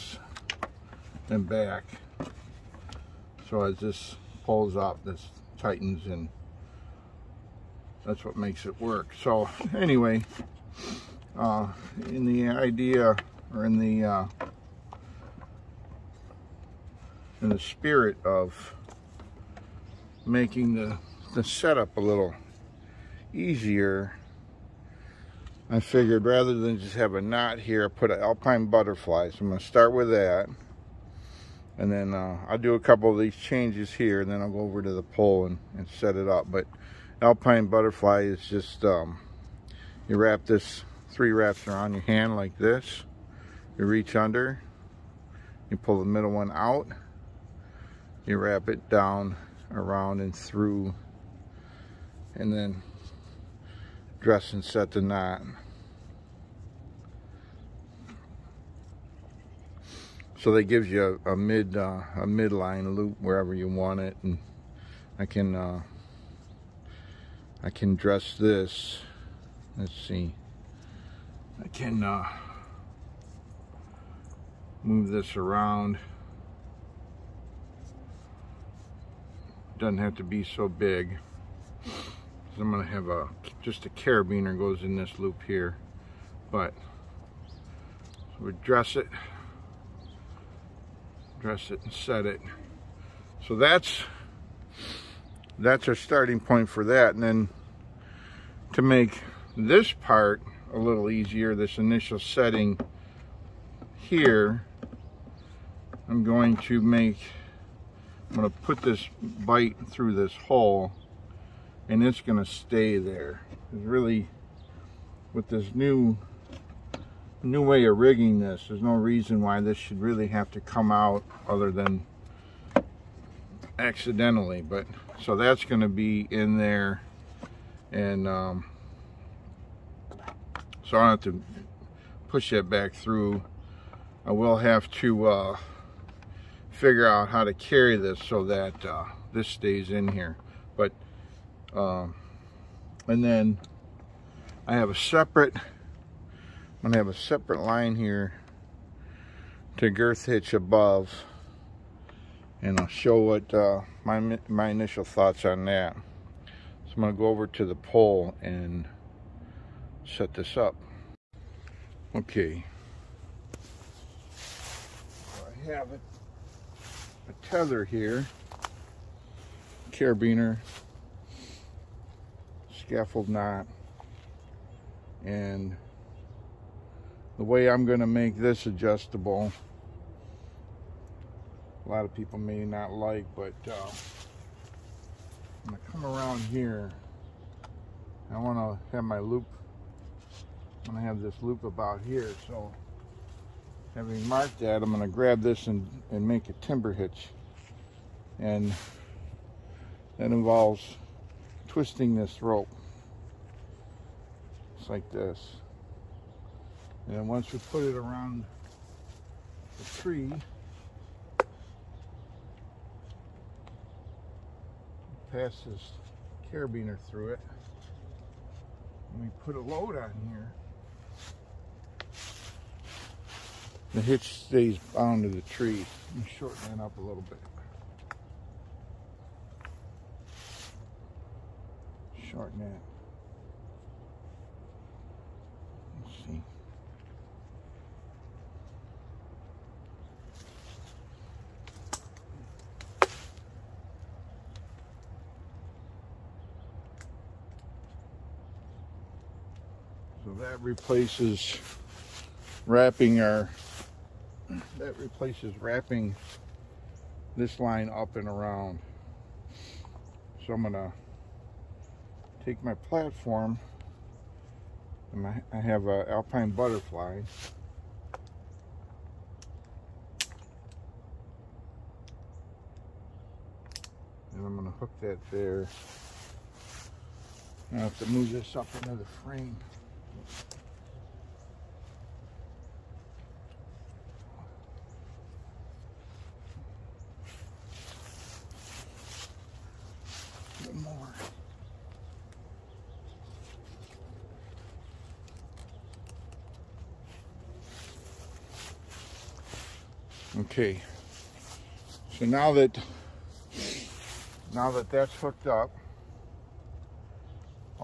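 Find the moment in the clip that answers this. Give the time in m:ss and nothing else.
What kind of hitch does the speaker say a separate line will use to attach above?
2:29.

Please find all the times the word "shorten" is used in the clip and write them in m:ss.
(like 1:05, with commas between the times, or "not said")
3:46, 3:52.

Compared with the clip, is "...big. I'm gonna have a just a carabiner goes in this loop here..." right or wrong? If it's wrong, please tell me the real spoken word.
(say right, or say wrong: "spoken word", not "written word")
right.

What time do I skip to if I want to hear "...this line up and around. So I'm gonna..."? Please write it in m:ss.
4:17.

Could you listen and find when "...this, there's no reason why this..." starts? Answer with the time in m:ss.
1:58.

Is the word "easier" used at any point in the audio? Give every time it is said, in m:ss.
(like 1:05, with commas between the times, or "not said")
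0:23, 1:41.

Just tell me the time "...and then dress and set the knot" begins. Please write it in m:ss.
0:52.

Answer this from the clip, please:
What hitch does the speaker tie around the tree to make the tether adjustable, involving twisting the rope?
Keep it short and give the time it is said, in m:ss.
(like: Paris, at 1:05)
timber hitch, at 3:16.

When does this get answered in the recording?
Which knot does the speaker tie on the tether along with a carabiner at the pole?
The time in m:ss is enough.
2:52.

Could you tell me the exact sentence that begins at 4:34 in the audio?
And I'm gonna hook that there.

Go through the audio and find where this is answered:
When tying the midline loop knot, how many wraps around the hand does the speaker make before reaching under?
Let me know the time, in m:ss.
0:41.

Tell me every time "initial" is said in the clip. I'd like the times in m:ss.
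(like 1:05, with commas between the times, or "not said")
1:41, 2:34.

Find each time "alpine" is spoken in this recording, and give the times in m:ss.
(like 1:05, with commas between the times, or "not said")
0:28, 0:37, 4:26.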